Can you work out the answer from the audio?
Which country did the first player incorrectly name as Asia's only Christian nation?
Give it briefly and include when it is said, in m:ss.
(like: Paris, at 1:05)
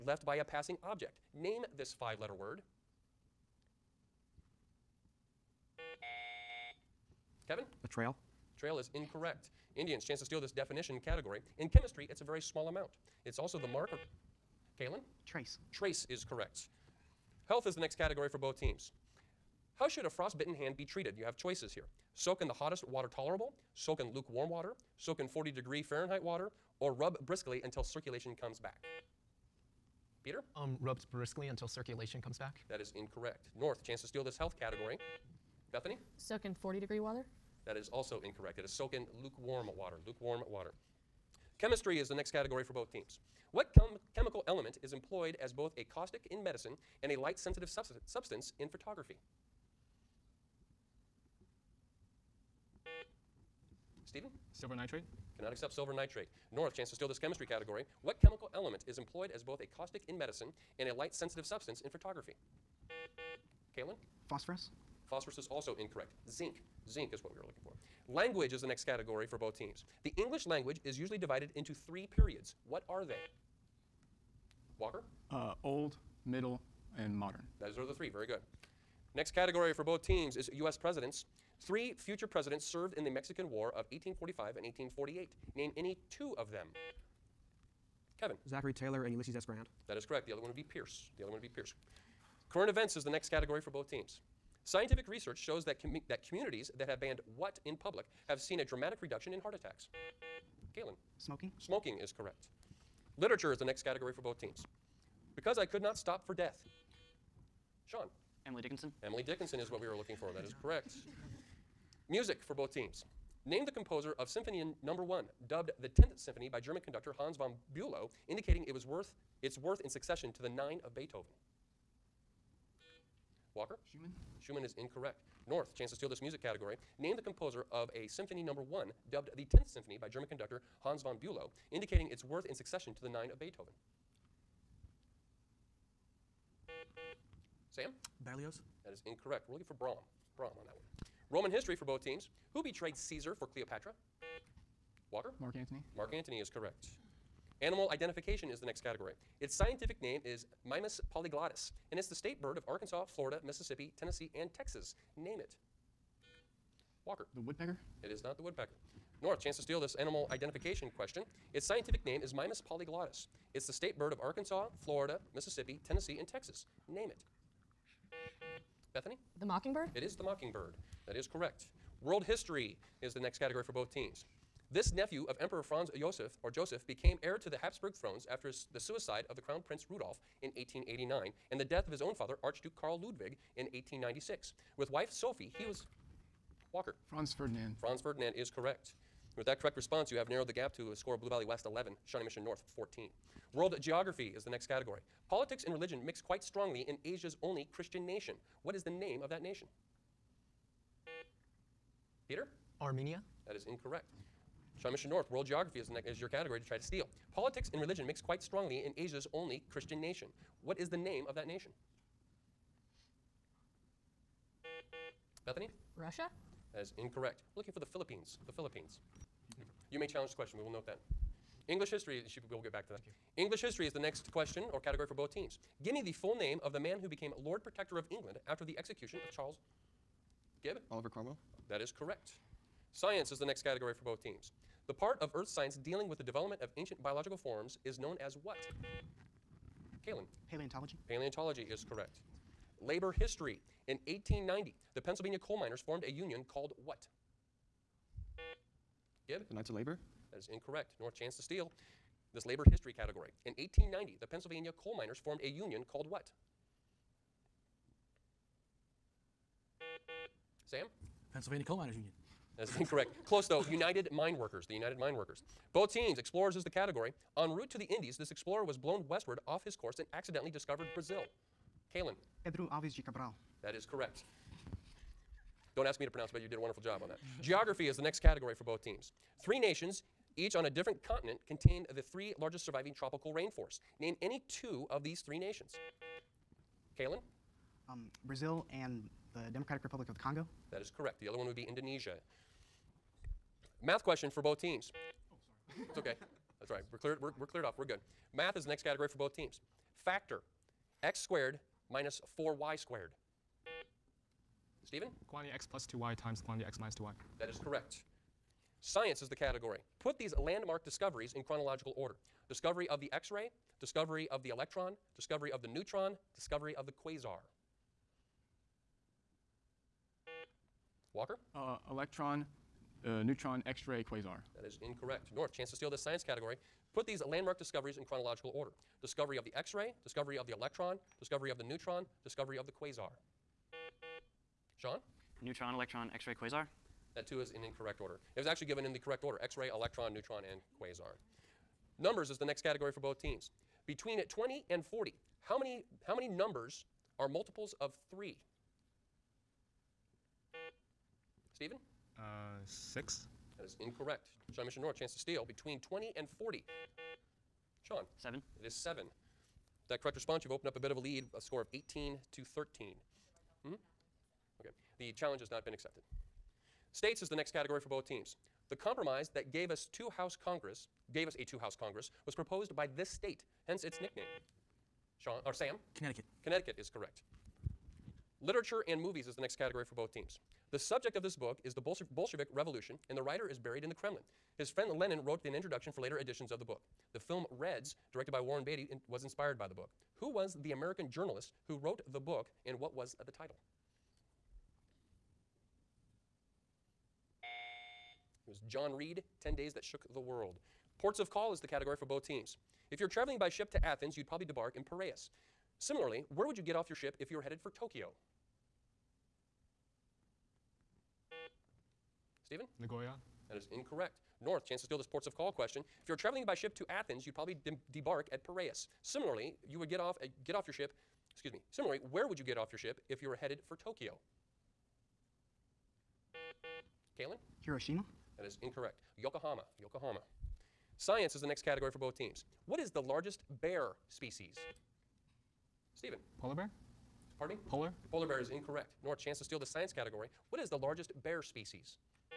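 Armenia, at 3:22.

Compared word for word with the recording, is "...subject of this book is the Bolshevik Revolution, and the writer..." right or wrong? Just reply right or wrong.
right.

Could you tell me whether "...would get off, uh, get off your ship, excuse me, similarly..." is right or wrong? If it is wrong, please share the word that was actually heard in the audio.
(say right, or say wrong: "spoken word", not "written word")
right.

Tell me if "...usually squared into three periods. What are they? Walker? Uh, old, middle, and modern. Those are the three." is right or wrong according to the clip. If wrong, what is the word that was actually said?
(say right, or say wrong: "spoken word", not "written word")
wrong: "divided", not "squared".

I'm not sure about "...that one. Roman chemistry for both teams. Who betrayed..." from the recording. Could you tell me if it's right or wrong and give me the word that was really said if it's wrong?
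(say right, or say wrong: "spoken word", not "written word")
wrong: "history", not "chemistry".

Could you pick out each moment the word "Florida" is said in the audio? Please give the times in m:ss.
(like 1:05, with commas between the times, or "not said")
2:33, 2:44.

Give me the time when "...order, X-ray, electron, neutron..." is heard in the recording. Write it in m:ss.
5:39.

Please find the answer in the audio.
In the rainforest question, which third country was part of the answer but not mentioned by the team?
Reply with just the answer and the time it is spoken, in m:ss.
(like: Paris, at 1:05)
Indonesia, at 4:51.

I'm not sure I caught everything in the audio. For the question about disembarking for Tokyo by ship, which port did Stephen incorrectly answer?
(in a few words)
Nagoya.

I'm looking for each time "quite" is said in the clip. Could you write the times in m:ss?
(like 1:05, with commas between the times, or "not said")
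3:16, 3:28.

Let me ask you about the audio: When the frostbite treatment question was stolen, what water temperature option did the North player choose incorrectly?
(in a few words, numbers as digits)
40 degrees.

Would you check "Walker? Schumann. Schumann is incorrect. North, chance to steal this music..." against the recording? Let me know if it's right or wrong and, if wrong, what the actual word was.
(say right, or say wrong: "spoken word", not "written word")
right.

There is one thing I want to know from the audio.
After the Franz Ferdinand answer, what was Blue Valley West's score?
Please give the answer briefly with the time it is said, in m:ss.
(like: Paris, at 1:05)
11, at 3:11.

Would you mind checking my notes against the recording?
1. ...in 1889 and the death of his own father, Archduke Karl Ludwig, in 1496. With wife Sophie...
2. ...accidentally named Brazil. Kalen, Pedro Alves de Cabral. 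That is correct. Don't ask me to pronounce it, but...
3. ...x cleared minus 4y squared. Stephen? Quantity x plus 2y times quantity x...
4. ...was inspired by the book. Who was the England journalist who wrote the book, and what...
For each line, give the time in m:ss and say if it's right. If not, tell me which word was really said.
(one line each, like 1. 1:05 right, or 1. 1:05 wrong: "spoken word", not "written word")
1. 3:00 wrong: "1896", not "1496"
2. 4:30 wrong: "discovered", not "named"
3. 5:01 wrong: "squared", not "cleared"
4. 6:29 wrong: "American", not "England".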